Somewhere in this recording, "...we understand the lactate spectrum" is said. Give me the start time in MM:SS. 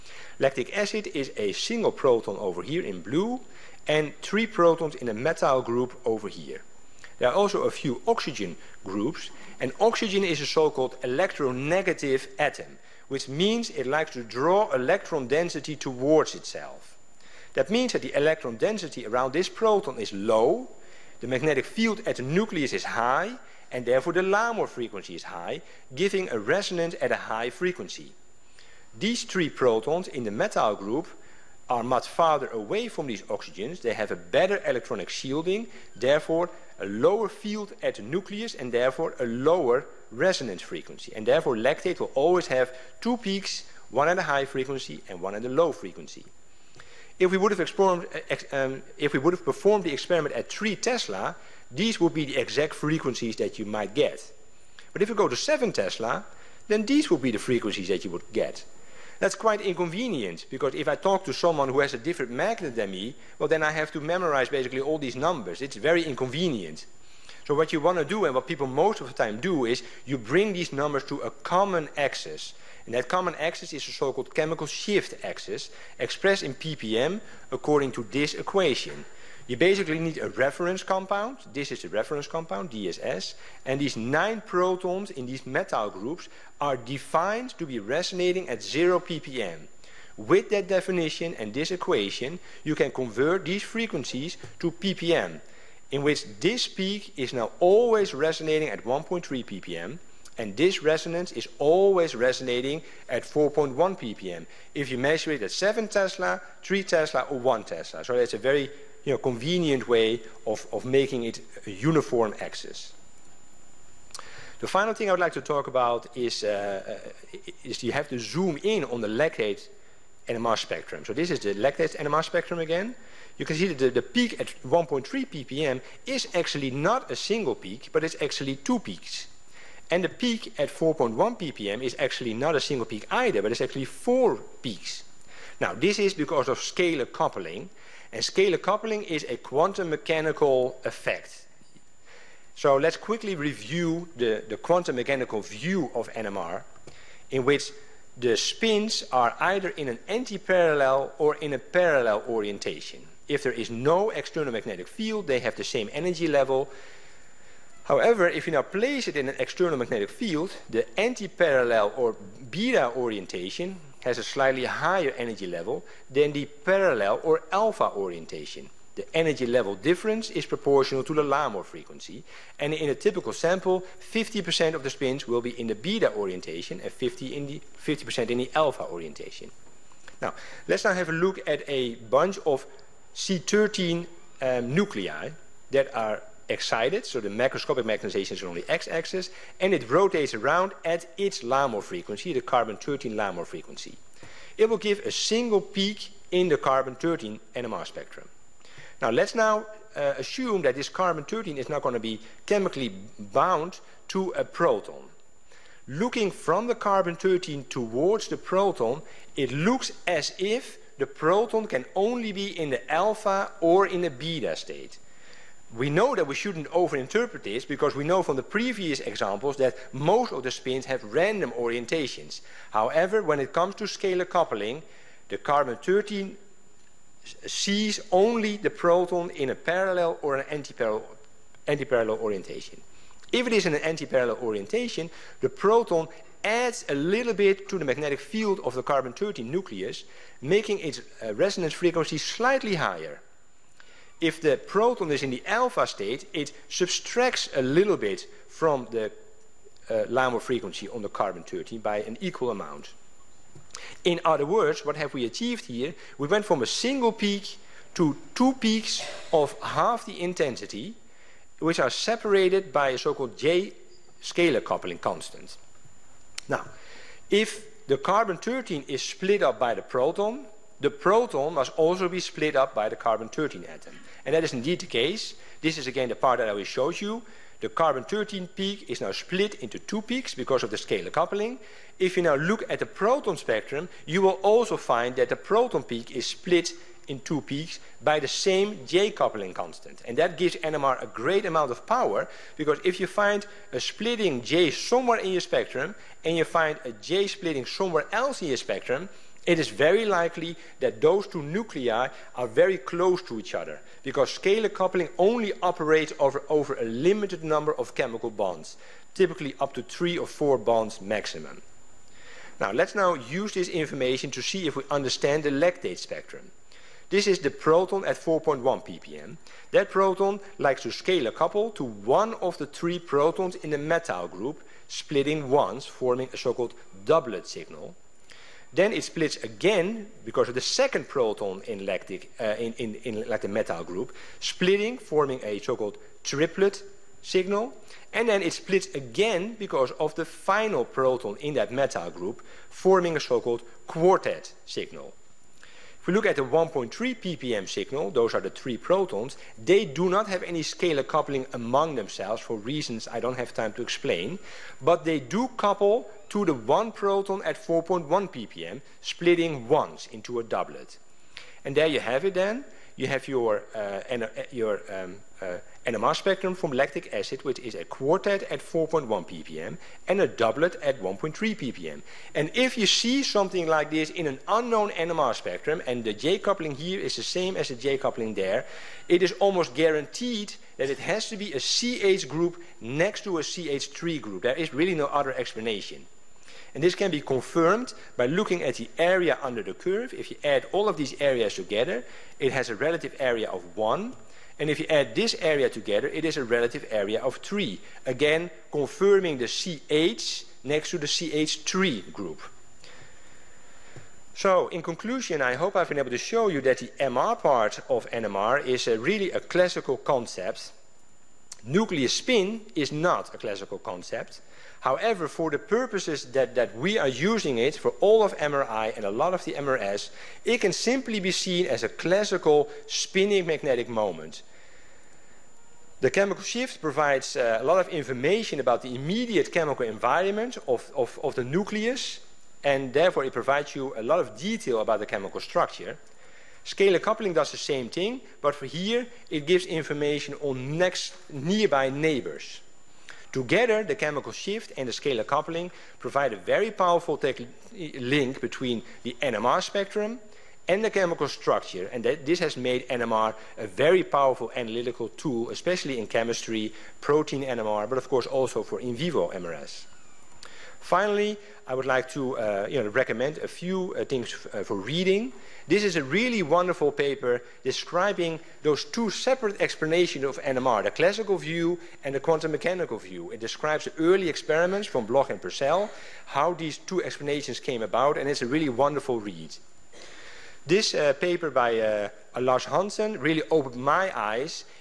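05:14.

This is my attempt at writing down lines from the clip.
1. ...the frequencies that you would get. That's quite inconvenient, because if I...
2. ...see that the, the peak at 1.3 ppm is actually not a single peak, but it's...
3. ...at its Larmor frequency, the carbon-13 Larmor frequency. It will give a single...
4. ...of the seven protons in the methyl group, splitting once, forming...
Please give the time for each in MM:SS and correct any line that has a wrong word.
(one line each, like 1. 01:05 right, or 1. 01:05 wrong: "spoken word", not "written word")
1. 00:57 right
2. 02:03 right
3. 03:10 right
4. 05:22 wrong: "three", not "seven".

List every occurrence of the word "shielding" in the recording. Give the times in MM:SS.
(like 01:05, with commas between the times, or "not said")
00:35.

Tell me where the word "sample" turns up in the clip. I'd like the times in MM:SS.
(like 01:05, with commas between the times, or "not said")
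02:53.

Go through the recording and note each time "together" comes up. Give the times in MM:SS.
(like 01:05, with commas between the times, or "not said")
06:31, 06:35, 07:23.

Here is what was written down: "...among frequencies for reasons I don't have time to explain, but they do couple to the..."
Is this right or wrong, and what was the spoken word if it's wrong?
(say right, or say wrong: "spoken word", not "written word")
wrong: "themselves", not "frequencies".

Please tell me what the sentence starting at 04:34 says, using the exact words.
And that is indeed the case.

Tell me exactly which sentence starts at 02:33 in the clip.
If there is no external magnetic field, they have the same energy level.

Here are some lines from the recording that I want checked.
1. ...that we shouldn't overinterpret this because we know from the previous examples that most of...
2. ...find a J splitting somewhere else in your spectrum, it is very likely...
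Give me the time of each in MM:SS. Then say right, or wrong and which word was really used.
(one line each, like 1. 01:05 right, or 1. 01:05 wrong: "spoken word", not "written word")
1. 03:36 right
2. 04:56 right.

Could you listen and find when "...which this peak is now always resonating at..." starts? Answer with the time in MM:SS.
01:36.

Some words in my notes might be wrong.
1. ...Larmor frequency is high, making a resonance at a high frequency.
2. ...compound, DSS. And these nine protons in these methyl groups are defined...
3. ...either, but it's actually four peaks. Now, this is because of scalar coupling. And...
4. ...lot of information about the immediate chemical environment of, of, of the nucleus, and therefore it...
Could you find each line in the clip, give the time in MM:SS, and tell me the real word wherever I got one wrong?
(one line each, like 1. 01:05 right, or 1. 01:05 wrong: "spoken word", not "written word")
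1. 00:24 wrong: "giving", not "making"
2. 01:22 right
3. 02:13 right
4. 07:07 right.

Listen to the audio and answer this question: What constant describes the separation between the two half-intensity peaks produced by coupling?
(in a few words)
J scalar coupling constant.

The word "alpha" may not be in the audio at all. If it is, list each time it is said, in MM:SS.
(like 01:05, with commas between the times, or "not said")
02:47, 02:58, 03:32, 04:05.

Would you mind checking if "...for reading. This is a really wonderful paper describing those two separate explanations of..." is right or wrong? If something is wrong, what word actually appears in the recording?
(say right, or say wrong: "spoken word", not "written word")
right.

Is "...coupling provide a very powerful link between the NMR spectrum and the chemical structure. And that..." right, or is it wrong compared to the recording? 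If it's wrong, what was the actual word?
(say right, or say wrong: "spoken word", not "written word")
right.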